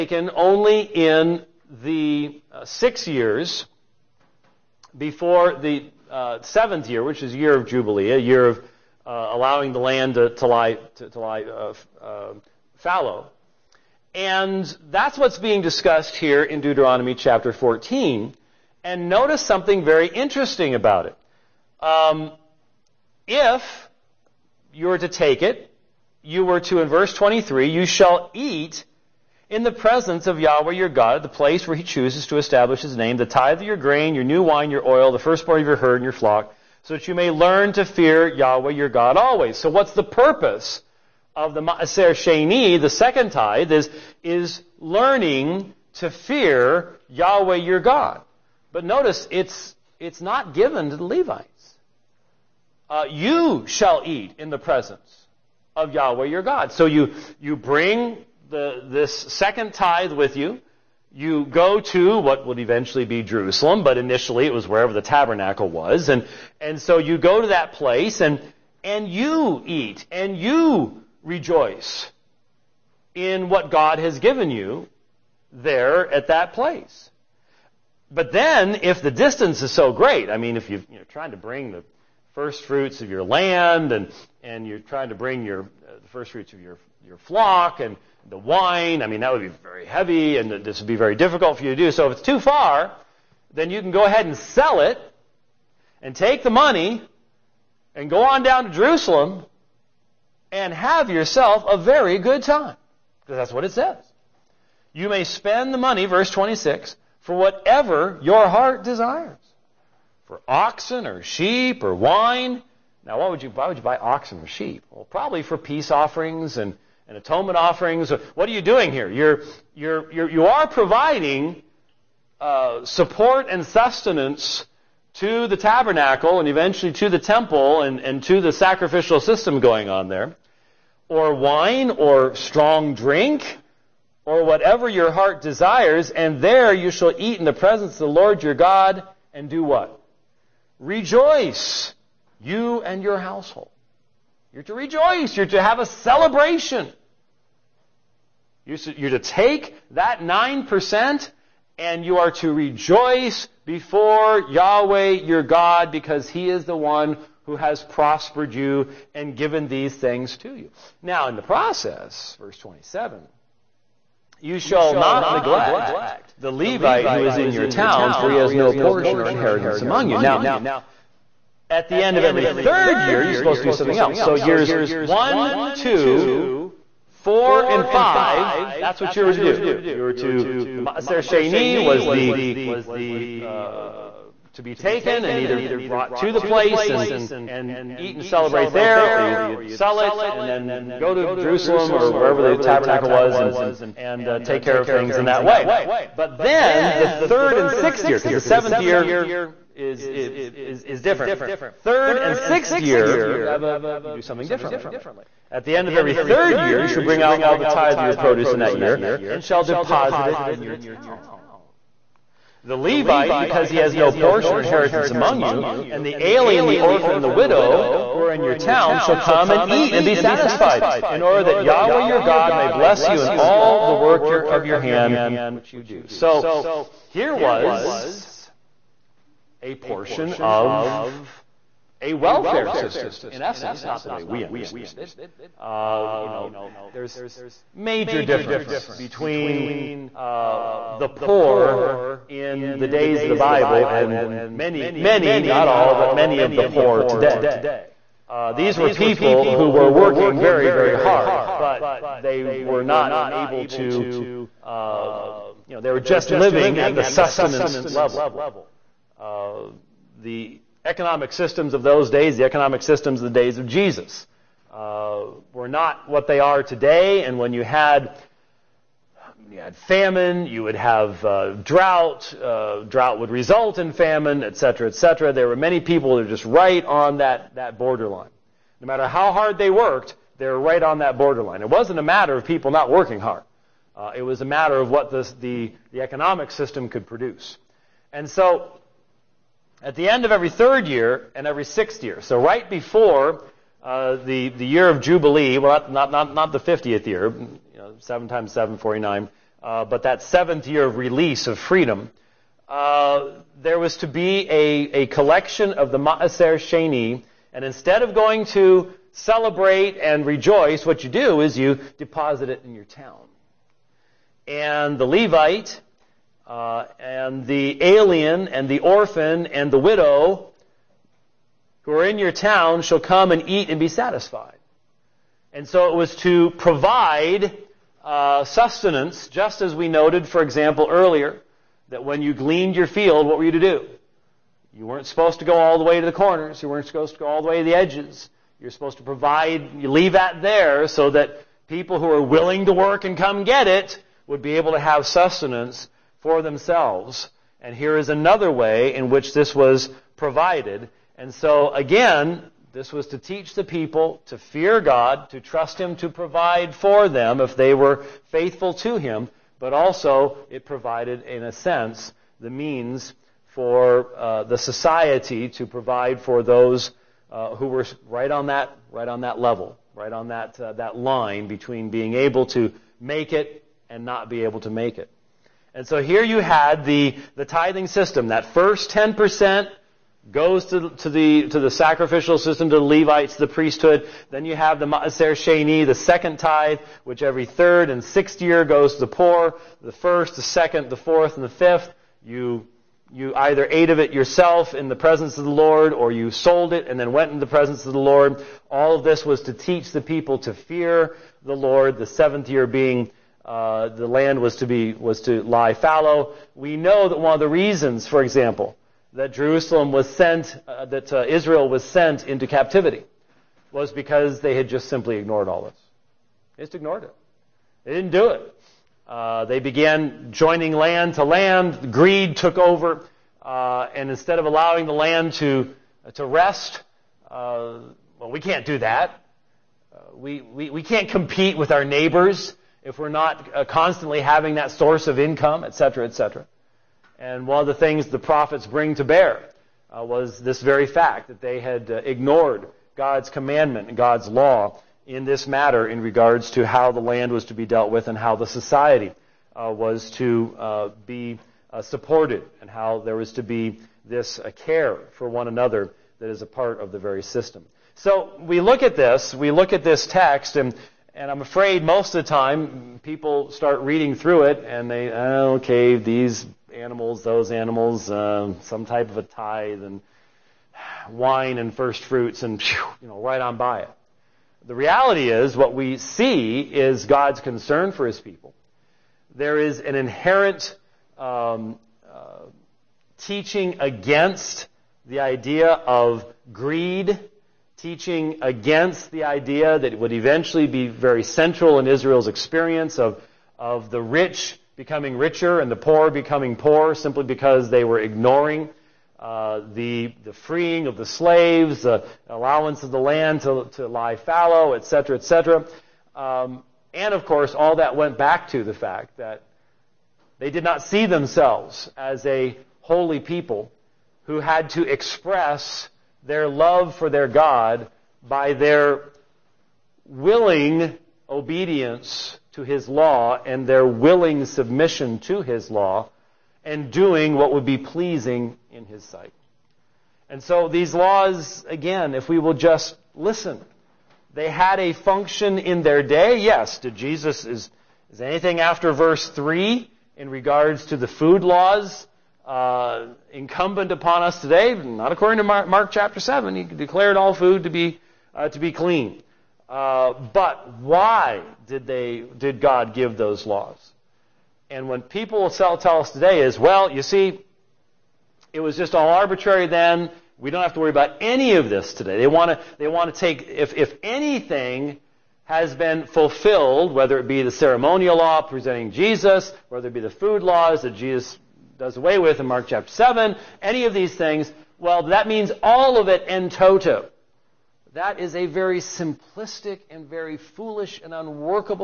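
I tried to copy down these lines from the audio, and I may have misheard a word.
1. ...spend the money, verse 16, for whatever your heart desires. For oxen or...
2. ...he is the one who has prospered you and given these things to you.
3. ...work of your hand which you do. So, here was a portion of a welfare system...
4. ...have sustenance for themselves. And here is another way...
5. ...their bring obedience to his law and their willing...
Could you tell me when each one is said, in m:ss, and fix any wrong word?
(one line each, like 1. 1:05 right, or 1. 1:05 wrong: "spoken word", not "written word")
1. 1:45 wrong: "26", not "16"
2. 2:36 right
3. 3:43 right
4. 5:44 right
5. 8:38 wrong: "willing", not "bring".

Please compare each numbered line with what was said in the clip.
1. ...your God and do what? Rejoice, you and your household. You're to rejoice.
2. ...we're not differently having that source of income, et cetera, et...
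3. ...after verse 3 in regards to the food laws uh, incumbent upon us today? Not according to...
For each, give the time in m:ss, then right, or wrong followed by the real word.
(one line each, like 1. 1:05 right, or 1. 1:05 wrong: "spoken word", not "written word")
1. 2:18 right
2. 7:12 wrong: "constantly", not "differently"
3. 8:58 right.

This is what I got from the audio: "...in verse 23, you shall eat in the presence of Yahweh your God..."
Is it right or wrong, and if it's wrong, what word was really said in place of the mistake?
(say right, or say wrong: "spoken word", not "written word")
right.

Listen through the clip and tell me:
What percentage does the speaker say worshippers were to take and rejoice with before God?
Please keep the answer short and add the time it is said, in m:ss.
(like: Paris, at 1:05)
9%, at 2:30.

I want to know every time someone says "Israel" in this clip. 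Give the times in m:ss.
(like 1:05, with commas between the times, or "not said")
6:51, 8:11.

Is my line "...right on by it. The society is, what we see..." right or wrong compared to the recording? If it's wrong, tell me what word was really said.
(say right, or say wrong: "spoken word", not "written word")
wrong: "reality", not "society".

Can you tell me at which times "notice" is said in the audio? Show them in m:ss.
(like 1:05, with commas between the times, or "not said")
0:19, 0:48.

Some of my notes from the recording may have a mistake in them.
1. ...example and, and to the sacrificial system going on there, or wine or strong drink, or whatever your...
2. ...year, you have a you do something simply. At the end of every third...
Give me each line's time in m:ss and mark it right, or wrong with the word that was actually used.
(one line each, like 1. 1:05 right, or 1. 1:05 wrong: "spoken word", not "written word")
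1. 2:07 wrong: "temple", not "example"
2. 3:22 wrong: "differently", not "simply".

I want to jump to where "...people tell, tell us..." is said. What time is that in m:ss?
9:15.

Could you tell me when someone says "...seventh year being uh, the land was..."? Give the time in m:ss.
6:42.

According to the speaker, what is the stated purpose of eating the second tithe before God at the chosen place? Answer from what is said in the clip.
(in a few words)
learn to fear Yahweh.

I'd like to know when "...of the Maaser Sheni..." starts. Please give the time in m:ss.
0:41.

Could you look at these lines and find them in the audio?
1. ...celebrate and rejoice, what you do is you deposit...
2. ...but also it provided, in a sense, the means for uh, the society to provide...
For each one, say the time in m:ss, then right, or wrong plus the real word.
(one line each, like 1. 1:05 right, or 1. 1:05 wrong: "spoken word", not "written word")
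1. 5:09 right
2. 5:59 right.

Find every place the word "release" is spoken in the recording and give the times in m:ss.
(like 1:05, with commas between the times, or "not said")
5:00.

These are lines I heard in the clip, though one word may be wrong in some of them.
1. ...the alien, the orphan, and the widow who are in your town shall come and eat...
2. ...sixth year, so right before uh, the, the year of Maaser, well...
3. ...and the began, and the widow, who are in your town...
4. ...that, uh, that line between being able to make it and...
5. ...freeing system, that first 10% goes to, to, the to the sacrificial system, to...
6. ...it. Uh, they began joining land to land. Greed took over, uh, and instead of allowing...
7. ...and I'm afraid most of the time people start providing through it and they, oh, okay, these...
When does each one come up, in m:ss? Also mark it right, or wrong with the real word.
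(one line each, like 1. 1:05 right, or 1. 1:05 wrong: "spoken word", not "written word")
1. 3:36 right
2. 4:51 wrong: "Jubilee", not "Maaser"
3. 5:18 wrong: "orphan", not "began"
4. 6:10 right
5. 6:17 wrong: "tithing", not "freeing"
6. 6:58 right
7. 7:41 wrong: "reading", not "providing".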